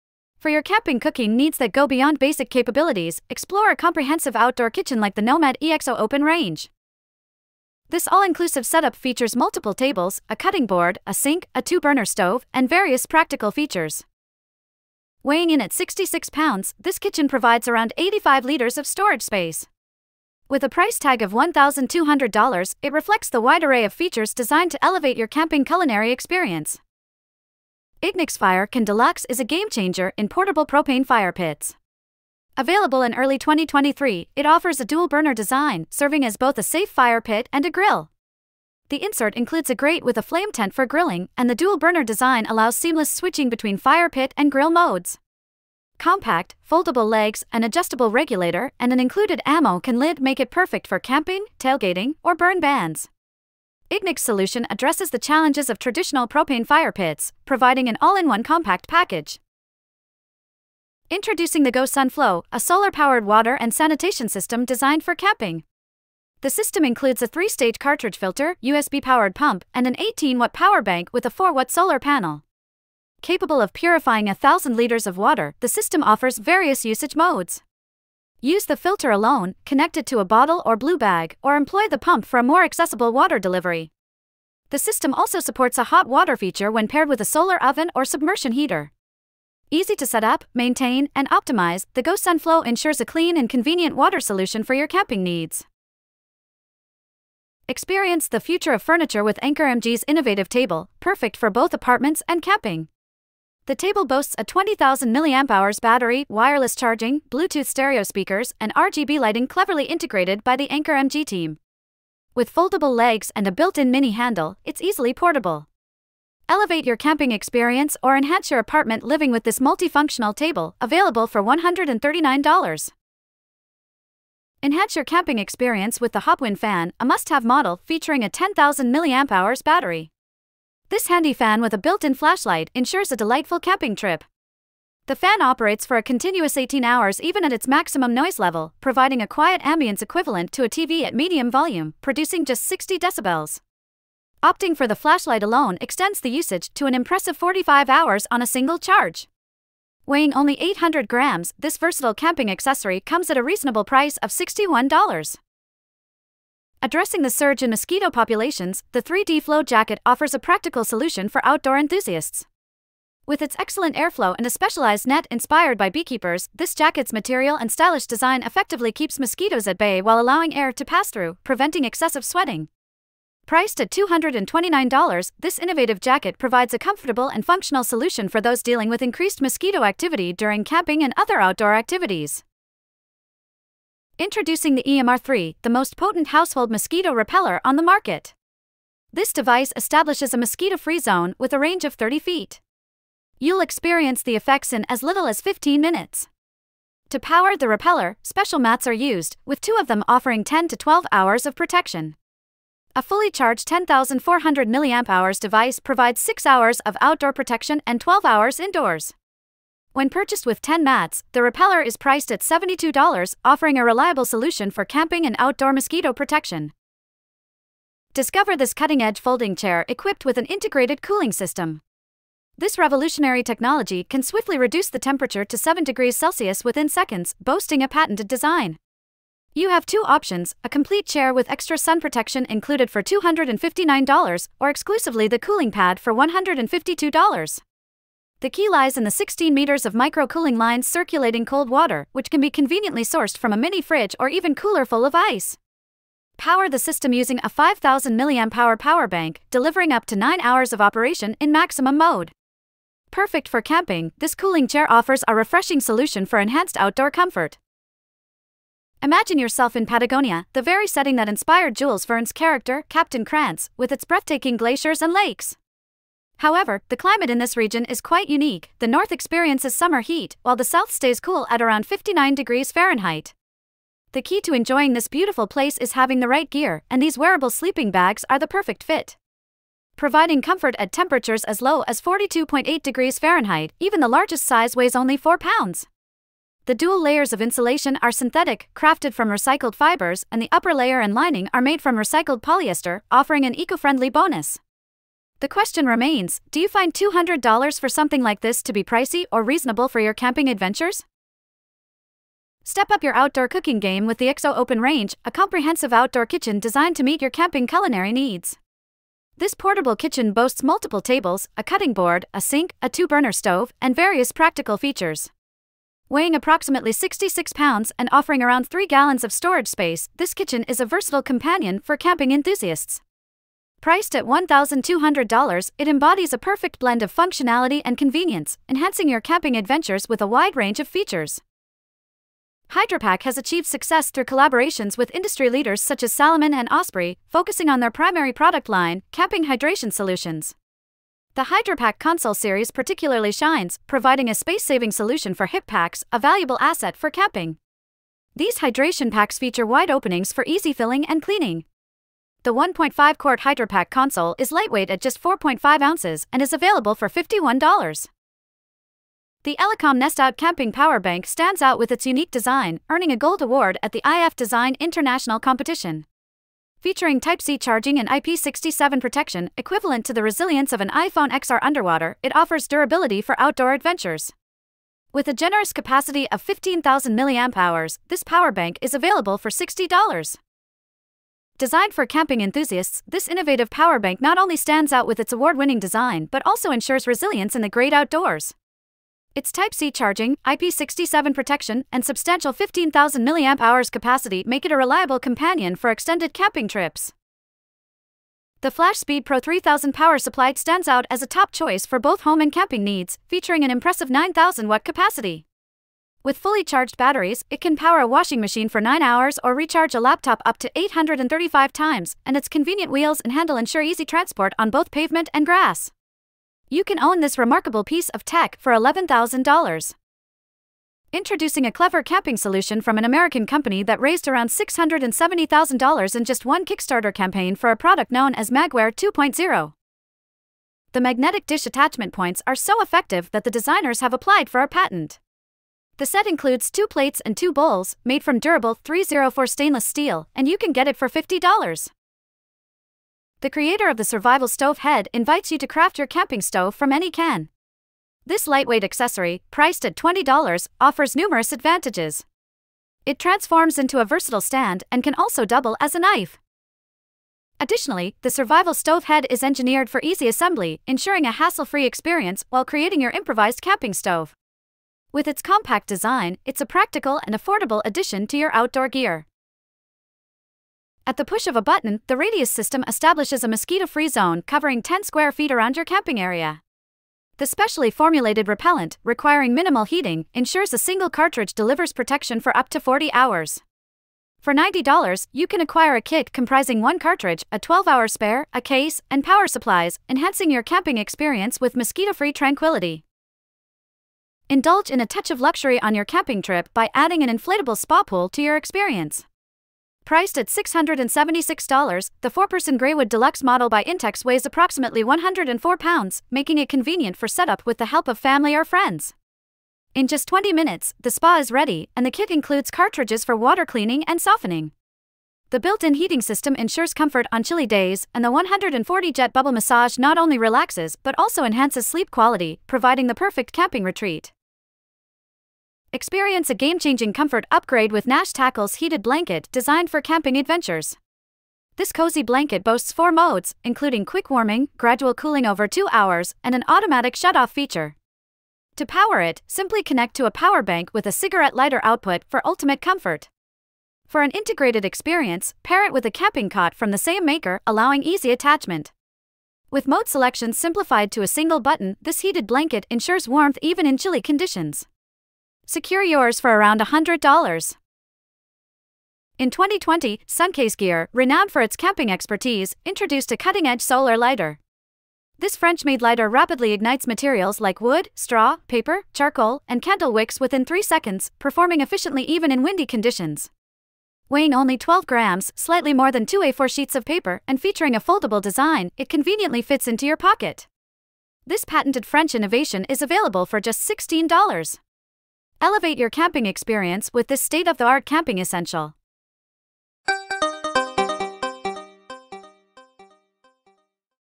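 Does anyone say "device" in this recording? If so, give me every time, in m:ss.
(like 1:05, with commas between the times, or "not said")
3:09, 3:25.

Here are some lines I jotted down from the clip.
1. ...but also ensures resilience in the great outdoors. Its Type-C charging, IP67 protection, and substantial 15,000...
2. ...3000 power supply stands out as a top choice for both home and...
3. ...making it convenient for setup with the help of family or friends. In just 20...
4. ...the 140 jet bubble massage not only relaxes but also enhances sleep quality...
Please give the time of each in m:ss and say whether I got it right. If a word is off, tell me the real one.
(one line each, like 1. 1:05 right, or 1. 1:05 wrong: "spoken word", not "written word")
1. 6:26 right
2. 6:39 right
3. 8:26 right
4. 8:38 right.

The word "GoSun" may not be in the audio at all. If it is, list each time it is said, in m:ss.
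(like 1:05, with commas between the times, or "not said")
1:01, 1:32.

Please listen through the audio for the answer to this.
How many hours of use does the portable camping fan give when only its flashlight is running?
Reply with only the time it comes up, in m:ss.
2:27.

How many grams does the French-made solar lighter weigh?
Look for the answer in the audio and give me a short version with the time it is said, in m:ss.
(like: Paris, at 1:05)
12 grams, at 9:34.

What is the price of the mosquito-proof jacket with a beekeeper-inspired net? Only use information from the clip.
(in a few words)
$229.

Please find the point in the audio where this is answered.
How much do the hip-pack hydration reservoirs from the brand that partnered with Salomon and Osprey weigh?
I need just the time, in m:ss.
5:55.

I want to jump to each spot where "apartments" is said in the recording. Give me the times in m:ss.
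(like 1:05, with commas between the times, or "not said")
1:41, 1:58.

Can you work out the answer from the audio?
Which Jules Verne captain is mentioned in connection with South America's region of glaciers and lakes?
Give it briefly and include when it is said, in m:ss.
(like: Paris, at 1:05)
Captain Krantz, at 4:22.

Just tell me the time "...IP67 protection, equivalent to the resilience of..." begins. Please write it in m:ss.
6:08.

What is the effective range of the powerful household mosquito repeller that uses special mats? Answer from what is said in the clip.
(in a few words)
30 feet.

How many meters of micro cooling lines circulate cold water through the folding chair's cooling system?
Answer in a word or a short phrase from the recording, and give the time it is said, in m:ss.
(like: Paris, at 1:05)
16 meters, at 3:59.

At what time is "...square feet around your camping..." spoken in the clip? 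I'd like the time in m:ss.
7:55.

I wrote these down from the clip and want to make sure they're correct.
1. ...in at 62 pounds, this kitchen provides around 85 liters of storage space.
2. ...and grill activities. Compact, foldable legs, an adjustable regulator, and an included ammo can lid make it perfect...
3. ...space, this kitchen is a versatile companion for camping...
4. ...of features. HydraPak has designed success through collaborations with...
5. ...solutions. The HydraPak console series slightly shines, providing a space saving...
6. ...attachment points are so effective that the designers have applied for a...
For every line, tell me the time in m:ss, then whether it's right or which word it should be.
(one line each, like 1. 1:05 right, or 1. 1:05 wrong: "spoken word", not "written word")
1. 0:15 wrong: "66", not "62"
2. 0:44 wrong: "modes", not "activities"
3. 5:19 right
4. 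5:30 wrong: "achieved", not "designed"
5. 5:39 wrong: "particularly", not "slightly"
6. 7:11 right.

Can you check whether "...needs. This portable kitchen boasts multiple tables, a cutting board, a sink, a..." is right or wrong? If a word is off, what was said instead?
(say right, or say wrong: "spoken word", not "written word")
right.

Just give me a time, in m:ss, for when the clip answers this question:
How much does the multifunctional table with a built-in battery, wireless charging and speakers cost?
2:01.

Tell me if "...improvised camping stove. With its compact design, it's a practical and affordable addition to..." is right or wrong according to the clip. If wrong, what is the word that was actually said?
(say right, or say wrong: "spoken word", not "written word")
right.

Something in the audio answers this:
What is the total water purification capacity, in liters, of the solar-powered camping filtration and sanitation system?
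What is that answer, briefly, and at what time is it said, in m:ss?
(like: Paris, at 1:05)
1,000 liters, at 1:14.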